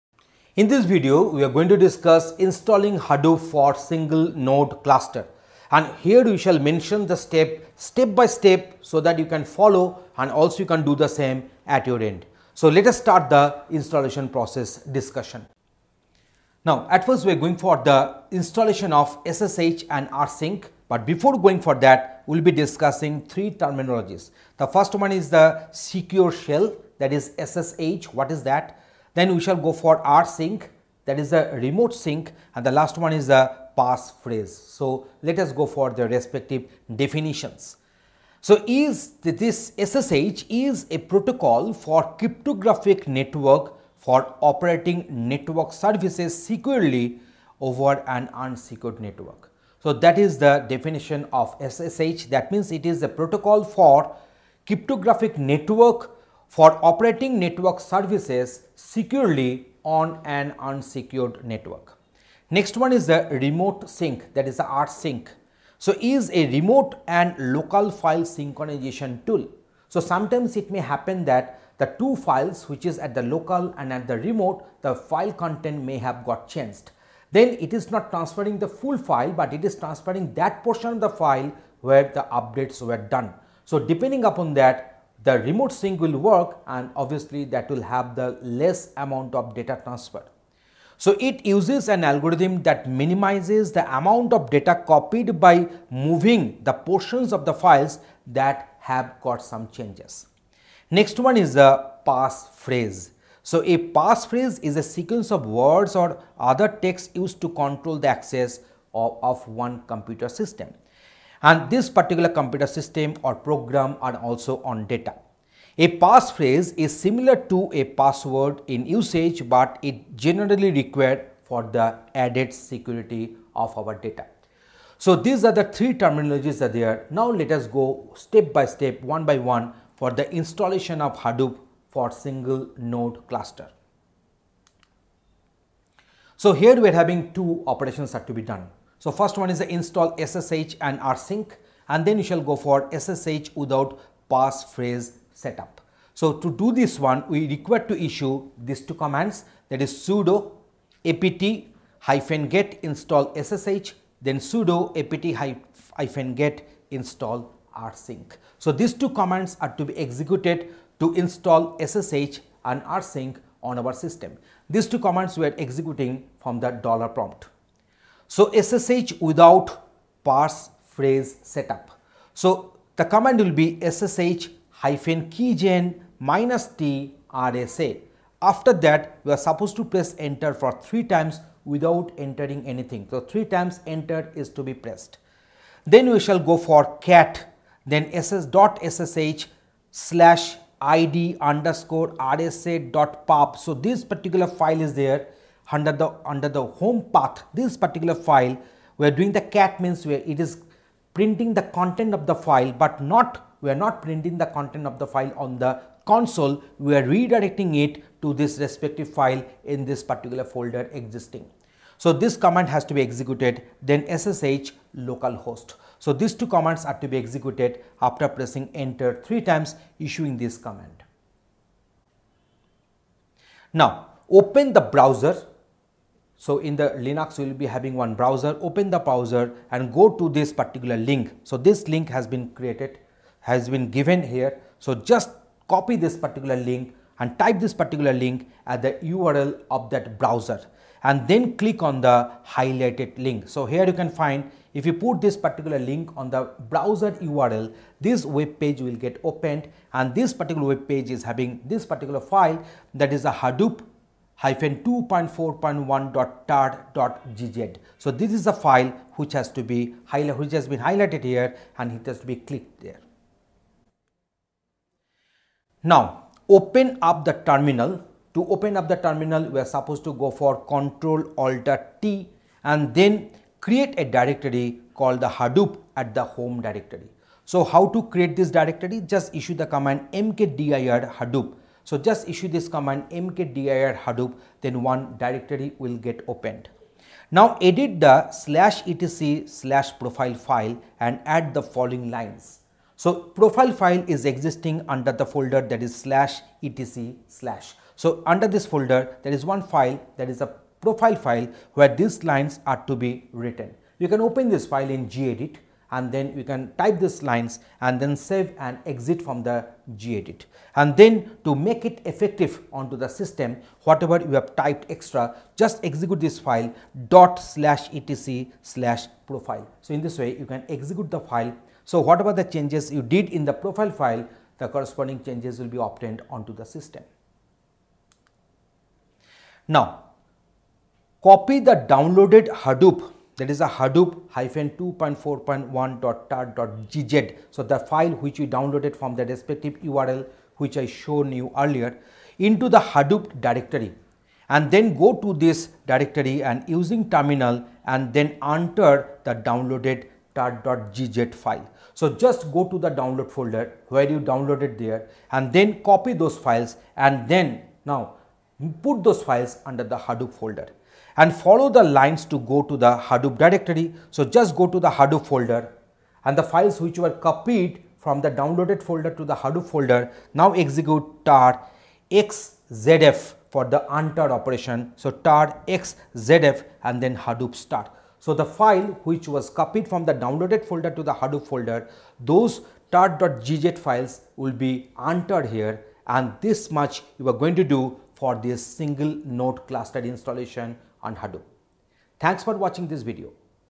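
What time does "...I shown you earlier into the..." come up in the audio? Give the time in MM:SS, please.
05:40.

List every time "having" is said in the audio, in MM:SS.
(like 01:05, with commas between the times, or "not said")
02:16, 03:47, 04:11.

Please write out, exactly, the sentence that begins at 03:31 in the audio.
So, this command has to be executed then ssh localhost.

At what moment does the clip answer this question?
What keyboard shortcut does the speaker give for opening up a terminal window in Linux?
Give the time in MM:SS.
04:30.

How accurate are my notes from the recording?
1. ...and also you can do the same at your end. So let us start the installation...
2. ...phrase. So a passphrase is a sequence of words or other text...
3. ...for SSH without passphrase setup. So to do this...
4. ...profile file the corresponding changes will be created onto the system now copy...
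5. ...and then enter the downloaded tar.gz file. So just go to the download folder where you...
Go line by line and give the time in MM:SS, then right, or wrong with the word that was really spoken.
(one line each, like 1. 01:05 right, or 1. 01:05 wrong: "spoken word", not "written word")
1. 00:10 right
2. 01:42 wrong: "passphrase", not "phrase"
3. 02:22 right
4. 05:23 wrong: "obtained", not "created"
5. 05:47 right.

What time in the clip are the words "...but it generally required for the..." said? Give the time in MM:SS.
01:59.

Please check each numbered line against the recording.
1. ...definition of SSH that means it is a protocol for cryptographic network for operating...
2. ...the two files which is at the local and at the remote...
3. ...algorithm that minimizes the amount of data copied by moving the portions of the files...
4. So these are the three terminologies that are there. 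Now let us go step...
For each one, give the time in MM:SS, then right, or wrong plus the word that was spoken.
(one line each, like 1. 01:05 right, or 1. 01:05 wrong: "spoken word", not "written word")
1. 00:50 right
2. 01:11 right
3. 01:32 right
4. 02:04 right.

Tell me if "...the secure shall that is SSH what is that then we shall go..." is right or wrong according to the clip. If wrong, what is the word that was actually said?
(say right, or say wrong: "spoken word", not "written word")
wrong: "shell", not "shall".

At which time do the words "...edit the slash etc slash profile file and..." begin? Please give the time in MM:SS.
04:47.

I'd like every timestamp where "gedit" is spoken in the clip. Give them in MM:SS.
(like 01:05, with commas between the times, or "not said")
05:05, 05:09.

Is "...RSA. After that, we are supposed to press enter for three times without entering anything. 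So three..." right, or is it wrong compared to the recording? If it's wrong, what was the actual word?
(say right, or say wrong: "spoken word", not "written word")
right.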